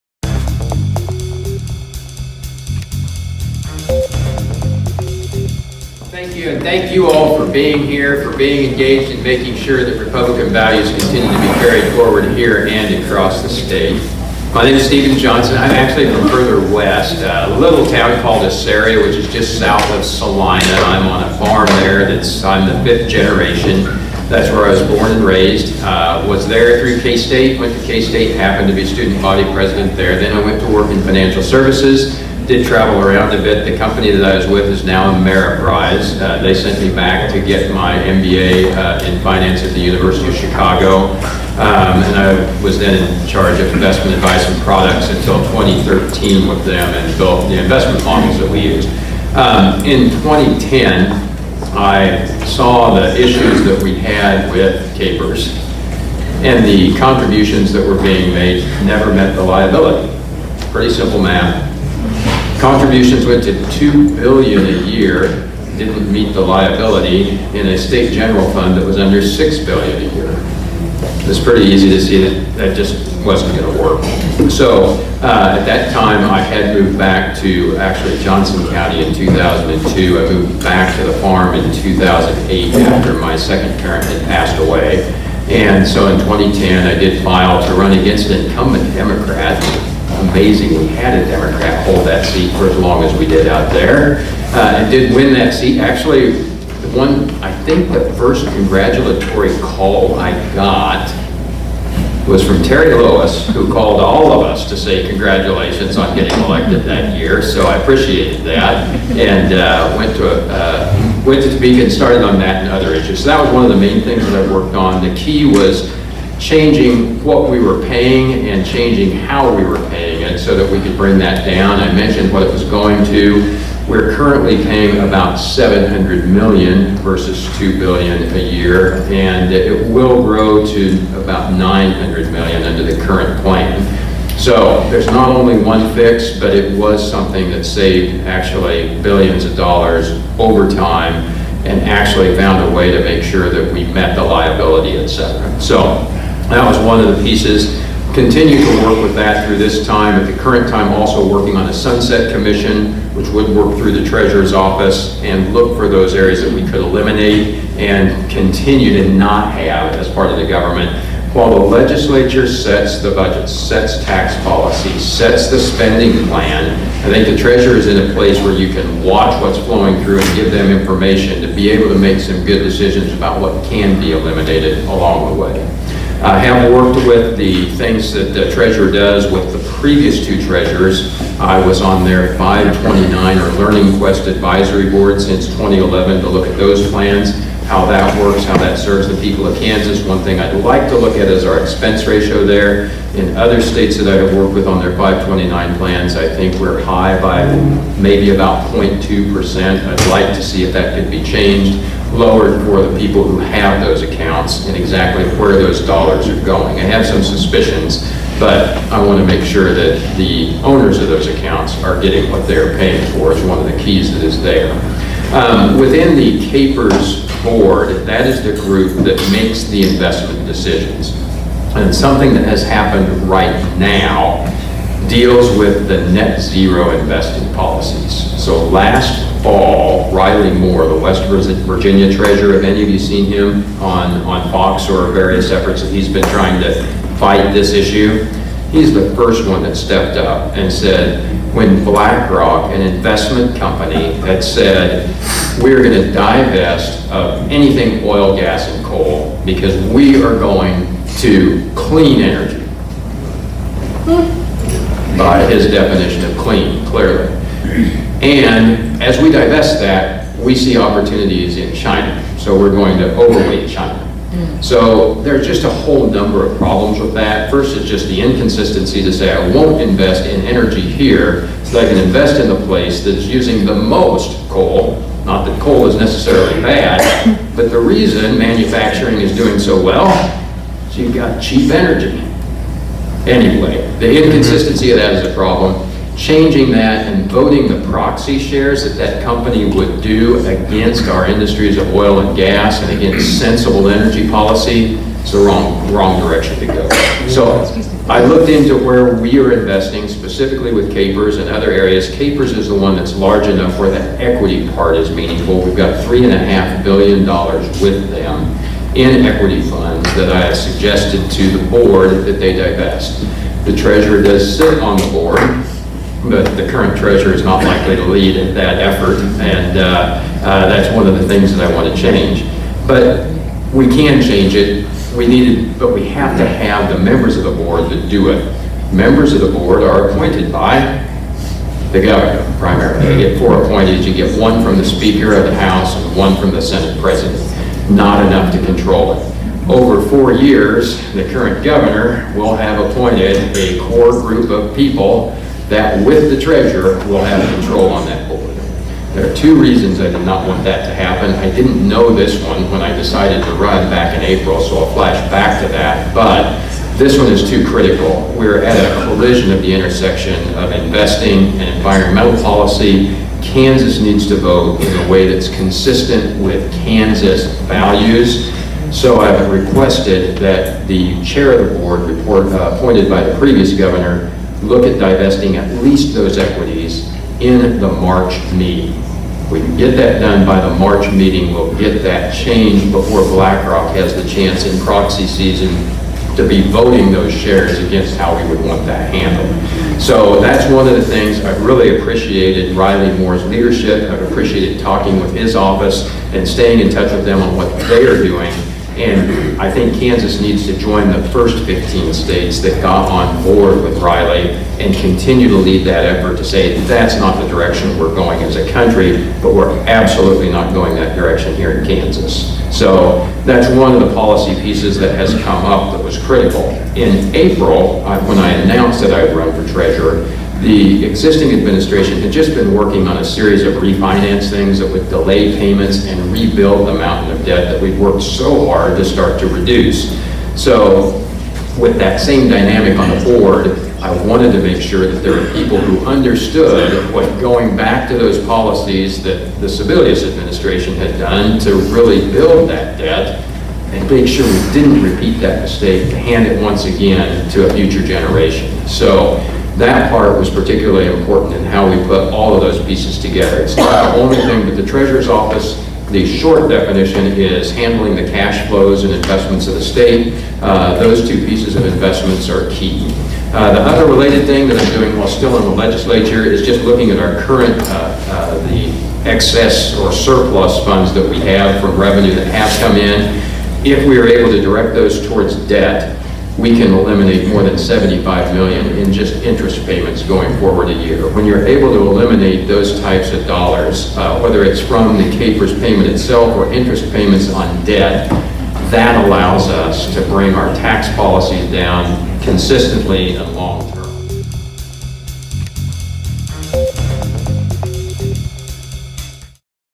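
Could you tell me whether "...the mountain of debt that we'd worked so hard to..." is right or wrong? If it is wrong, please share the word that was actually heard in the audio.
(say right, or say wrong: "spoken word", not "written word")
right.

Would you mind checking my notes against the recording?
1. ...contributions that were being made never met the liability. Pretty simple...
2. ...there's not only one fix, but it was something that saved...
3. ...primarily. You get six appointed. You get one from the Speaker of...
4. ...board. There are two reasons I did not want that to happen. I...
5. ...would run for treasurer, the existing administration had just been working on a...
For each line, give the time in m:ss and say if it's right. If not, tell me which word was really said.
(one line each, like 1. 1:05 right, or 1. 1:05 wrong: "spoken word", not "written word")
1. 0:56 right
2. 2:14 right
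3. 5:32 wrong: "four", not "six"
4. 5:48 right
5. 6:59 right.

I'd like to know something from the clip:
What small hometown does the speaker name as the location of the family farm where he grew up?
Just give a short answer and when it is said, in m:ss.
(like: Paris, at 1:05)
Assaria, at 0:18.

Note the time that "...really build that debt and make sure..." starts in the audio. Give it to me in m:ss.
7:21.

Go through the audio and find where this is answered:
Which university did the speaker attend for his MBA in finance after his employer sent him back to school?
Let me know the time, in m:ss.
0:39.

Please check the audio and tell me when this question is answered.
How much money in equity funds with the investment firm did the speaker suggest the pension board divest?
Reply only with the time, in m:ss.
5:06.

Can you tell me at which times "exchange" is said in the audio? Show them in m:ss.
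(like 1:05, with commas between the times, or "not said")
not said.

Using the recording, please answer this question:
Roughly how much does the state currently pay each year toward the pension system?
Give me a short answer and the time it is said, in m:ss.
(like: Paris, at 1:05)
700 million, at 2:05.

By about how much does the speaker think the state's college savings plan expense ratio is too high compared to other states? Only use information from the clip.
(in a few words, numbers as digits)
0.2%.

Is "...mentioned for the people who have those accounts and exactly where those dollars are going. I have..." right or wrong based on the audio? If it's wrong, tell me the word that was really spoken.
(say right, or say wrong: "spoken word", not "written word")
wrong: "lowered", not "mentioned".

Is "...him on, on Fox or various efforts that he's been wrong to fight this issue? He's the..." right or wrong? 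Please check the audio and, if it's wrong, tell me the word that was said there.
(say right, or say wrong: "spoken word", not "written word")
wrong: "trying", not "wrong".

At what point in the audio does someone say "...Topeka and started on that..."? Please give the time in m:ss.
1:51.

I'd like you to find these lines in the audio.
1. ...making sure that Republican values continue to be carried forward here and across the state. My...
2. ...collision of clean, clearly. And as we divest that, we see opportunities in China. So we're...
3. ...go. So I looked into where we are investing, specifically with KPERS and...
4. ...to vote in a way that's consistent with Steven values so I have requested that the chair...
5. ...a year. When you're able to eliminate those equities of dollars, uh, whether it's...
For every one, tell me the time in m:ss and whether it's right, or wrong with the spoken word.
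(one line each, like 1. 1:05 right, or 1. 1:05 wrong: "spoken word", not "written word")
1. 0:09 right
2. 4:15 wrong: "definition", not "collision"
3. 4:56 right
4. 6:04 wrong: "Kansas", not "Steven"
5. 8:00 wrong: "types", not "equities".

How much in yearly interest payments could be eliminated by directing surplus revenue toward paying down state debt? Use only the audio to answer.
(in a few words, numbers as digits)
75 million.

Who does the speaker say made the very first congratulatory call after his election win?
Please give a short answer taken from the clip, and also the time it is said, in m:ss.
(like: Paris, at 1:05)
Terry Lewis, at 1:42.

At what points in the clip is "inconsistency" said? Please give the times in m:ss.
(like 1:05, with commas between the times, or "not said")
4:28, 4:44.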